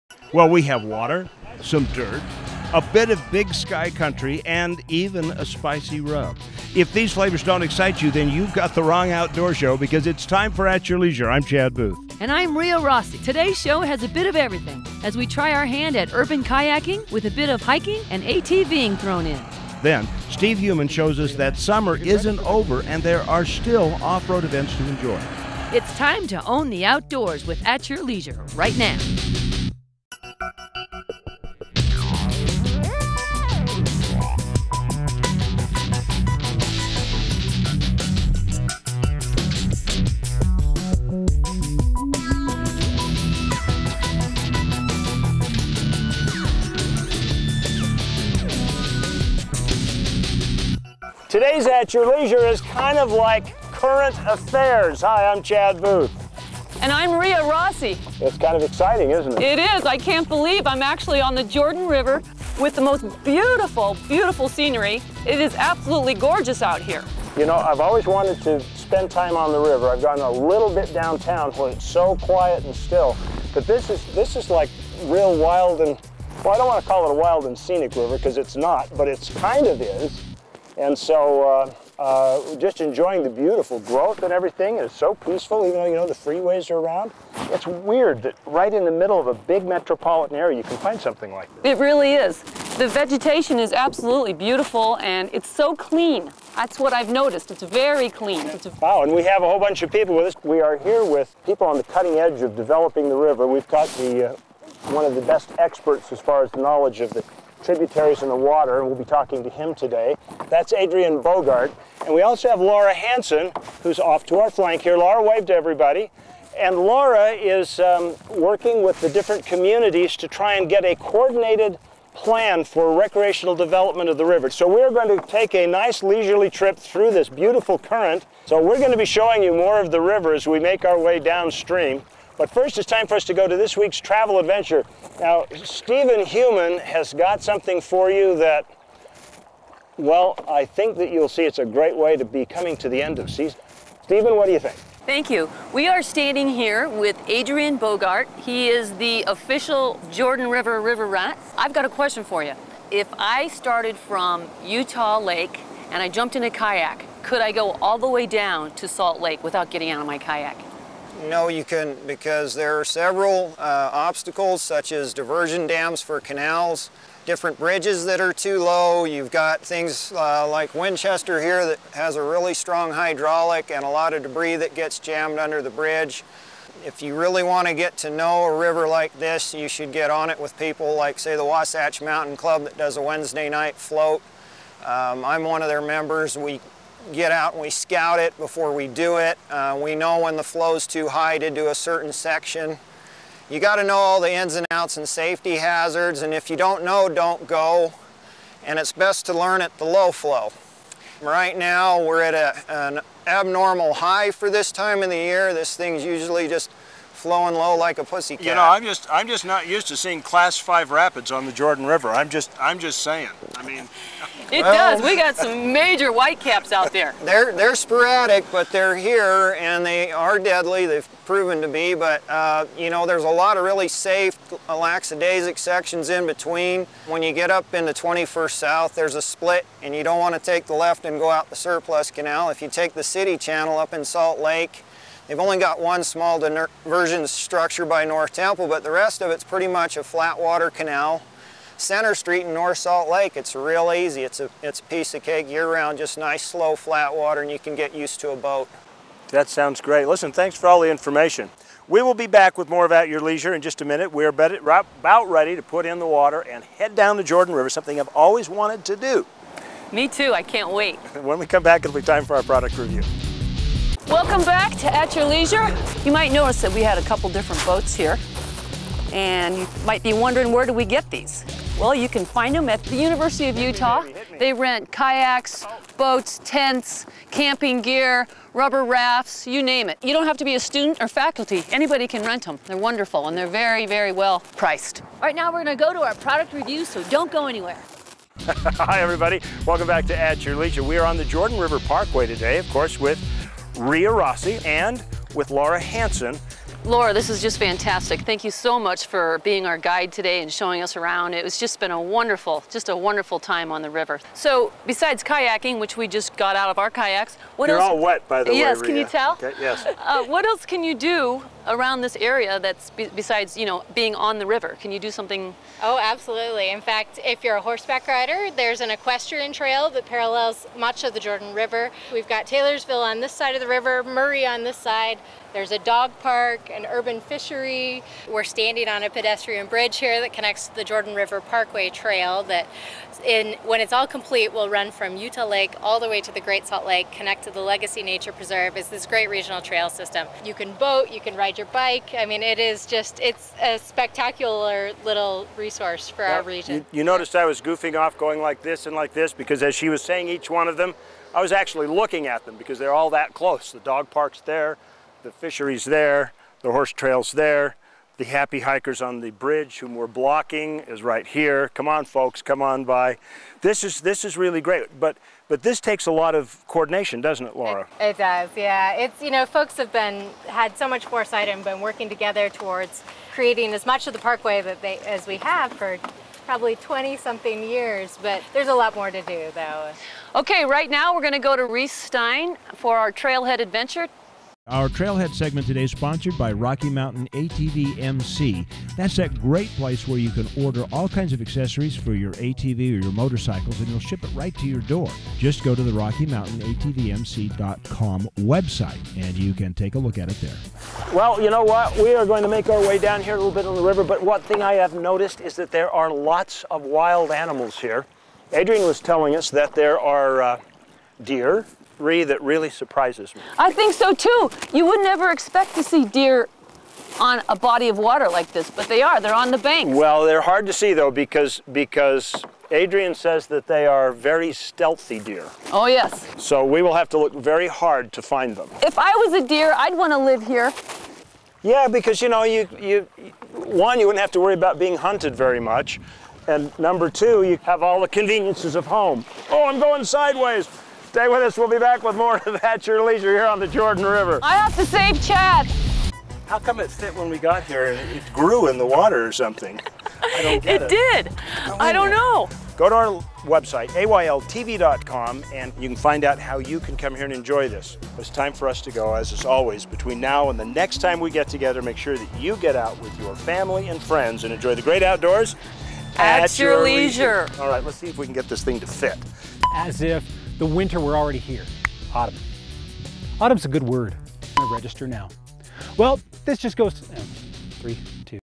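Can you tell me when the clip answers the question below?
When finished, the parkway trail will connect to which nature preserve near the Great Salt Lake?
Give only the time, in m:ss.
5:37.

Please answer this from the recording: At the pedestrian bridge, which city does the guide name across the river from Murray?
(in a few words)
Taylorsville.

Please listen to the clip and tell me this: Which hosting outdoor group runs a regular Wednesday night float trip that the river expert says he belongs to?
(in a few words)
Wasatch Mountain Club.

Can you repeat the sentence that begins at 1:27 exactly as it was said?
It's weird that right in the middle of a big metropolitan area, you can find something like this.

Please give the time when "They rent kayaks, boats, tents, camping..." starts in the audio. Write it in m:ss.
4:34.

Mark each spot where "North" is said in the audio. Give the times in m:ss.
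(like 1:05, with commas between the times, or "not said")
3:58, 4:02.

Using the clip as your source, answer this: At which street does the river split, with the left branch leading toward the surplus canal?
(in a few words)
21st South.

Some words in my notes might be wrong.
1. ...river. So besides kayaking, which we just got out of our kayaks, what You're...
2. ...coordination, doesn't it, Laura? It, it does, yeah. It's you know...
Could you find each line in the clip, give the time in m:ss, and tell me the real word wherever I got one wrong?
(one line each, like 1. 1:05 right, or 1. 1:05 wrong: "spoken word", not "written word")
1. 5:03 right
2. 6:06 right.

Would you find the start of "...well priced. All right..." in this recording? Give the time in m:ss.
4:44.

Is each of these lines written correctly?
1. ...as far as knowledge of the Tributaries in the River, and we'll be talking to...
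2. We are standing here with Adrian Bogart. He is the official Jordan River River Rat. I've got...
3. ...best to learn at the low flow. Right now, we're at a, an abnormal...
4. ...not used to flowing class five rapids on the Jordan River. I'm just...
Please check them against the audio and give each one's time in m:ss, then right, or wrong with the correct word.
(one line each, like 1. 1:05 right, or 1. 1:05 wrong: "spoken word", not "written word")
1. 1:46 wrong: "Water", not "River"
2. 2:25 right
3. 3:18 right
4. 3:29 wrong: "seeing", not "flowing".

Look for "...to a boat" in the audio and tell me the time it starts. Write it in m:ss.
4:08.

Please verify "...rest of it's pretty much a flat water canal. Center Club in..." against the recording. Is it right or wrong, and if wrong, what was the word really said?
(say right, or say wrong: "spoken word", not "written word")
wrong: "Street", not "Club".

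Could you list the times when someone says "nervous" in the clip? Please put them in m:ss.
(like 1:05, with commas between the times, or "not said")
not said.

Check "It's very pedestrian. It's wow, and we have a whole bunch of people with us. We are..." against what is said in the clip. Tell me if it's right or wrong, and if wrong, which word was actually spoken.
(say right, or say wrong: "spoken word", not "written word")
wrong: "clean", not "pedestrian".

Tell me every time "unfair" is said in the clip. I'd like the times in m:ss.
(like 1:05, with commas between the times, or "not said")
not said.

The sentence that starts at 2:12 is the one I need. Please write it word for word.
But first, it's time for us to go to this week's travel adventure.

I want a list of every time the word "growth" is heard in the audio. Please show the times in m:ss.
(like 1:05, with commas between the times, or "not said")
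1:23.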